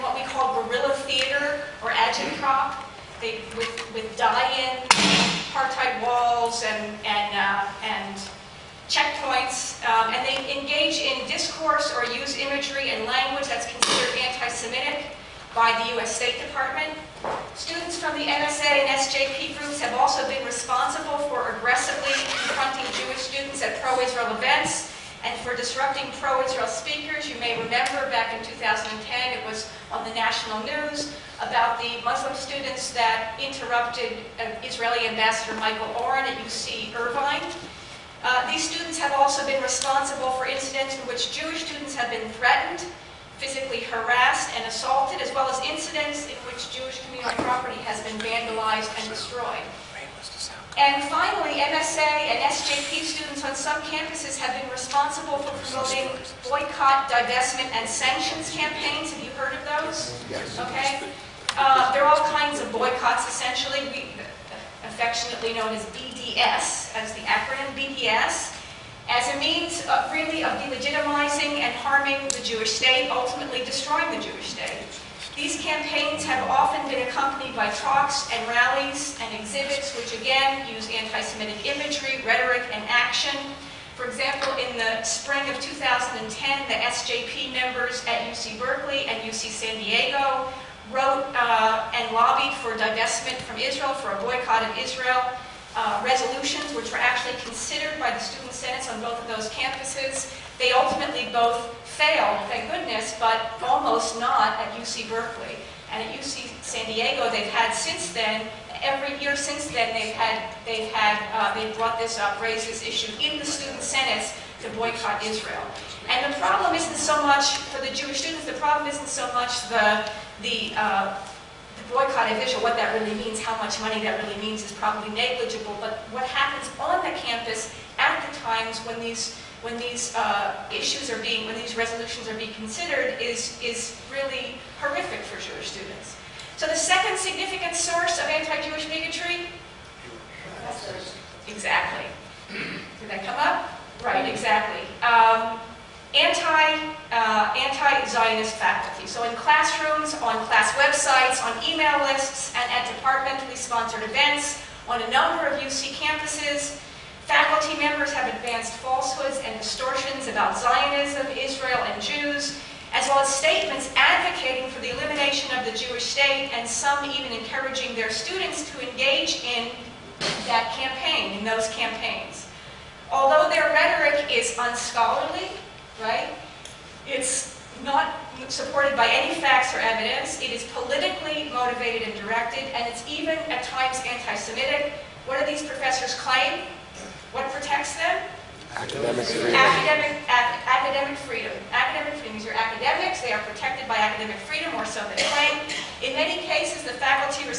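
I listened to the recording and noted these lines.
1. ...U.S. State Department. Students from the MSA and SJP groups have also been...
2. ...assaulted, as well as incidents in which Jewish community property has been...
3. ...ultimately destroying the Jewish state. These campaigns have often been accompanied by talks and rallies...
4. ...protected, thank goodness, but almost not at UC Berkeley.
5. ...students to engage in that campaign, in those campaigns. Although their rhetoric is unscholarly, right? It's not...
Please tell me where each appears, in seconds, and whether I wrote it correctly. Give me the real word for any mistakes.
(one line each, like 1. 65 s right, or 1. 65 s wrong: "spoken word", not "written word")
1. 15 s right
2. 44 s right
3. 73 s right
4. 101 s wrong: "failed", not "protected"
5. 168 s right.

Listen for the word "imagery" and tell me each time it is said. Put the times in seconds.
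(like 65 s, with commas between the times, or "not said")
12 s, 81 s.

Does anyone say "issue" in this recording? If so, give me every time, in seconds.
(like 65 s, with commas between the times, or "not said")
112 s, 130 s.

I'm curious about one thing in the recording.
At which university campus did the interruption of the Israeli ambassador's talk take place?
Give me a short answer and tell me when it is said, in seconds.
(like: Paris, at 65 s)
UC Irvine, at 36 s.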